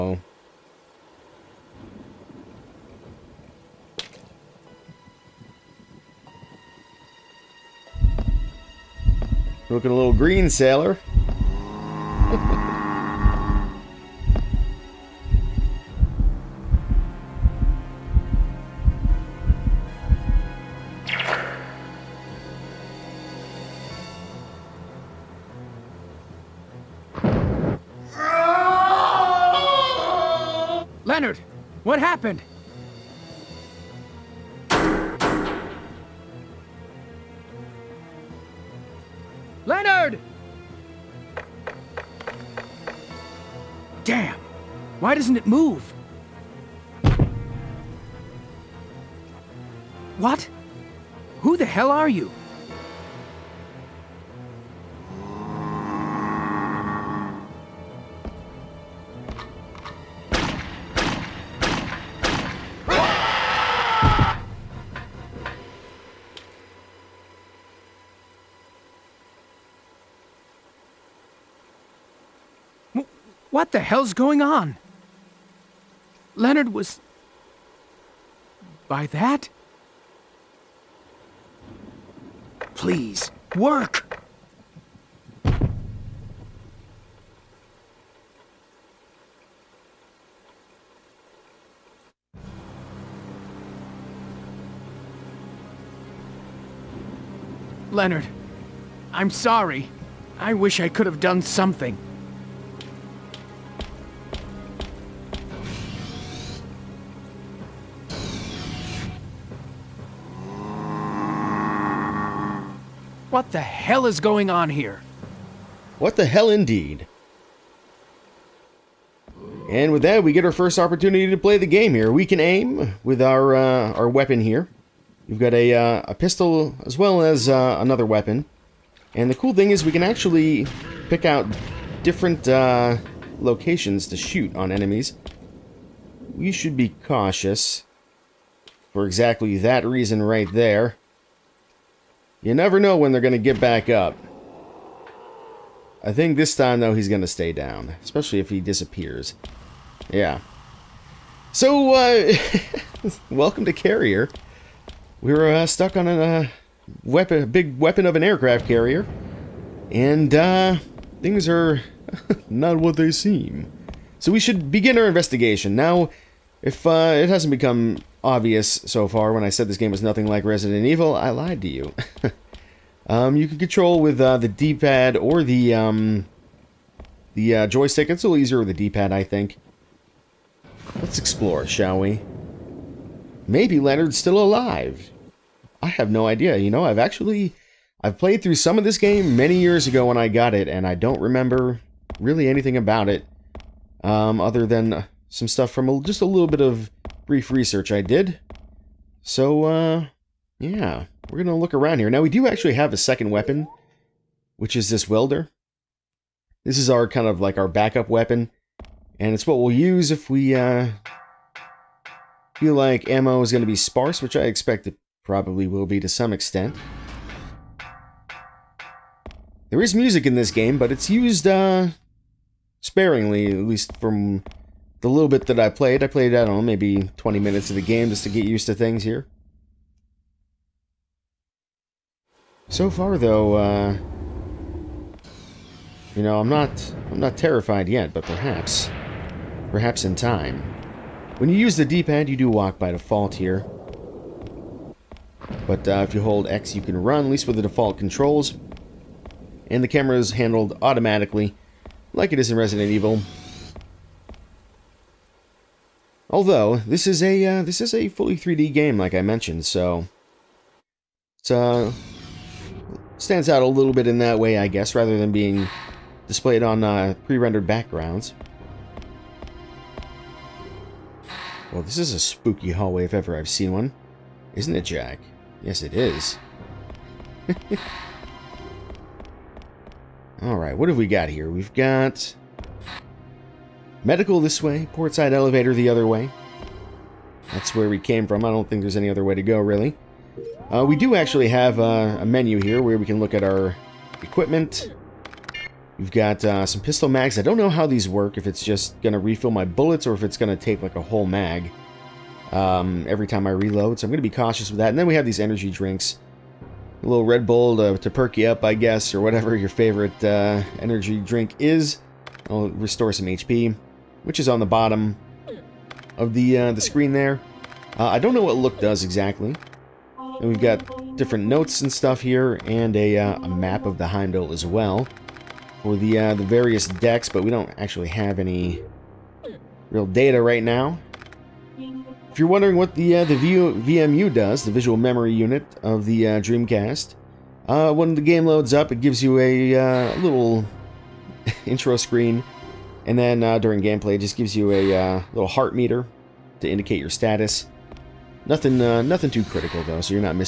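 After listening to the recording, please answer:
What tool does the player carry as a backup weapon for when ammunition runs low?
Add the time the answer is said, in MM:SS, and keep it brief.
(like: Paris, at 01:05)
welder, at 03:25.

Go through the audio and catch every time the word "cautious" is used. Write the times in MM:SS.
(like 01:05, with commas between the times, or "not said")
02:17, 05:04.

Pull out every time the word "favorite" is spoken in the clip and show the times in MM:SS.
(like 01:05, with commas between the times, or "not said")
05:09.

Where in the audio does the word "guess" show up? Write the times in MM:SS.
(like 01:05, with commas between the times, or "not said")
04:24, 05:08.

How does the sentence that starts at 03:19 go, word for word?
So, uh, yeah, we're going to look around here.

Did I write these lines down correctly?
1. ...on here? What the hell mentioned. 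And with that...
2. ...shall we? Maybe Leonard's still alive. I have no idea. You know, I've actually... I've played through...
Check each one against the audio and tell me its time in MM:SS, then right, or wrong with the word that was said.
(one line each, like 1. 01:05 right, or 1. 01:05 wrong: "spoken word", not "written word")
1. 01:54 wrong: "indeed", not "mentioned"
2. 03:01 right.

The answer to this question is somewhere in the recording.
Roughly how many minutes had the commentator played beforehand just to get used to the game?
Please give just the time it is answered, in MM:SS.
03:47.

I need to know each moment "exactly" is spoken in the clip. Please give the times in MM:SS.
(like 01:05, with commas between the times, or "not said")
02:19, 05:19.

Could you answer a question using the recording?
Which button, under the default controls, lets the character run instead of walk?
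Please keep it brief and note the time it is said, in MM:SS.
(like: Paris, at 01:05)
X, at 04:06.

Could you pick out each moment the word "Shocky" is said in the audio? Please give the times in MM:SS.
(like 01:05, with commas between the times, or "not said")
not said.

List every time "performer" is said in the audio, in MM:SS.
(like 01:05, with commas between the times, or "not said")
not said.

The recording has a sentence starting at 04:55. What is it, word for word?
We've got uh, some pistol mags.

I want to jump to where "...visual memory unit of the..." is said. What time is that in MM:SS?
05:34.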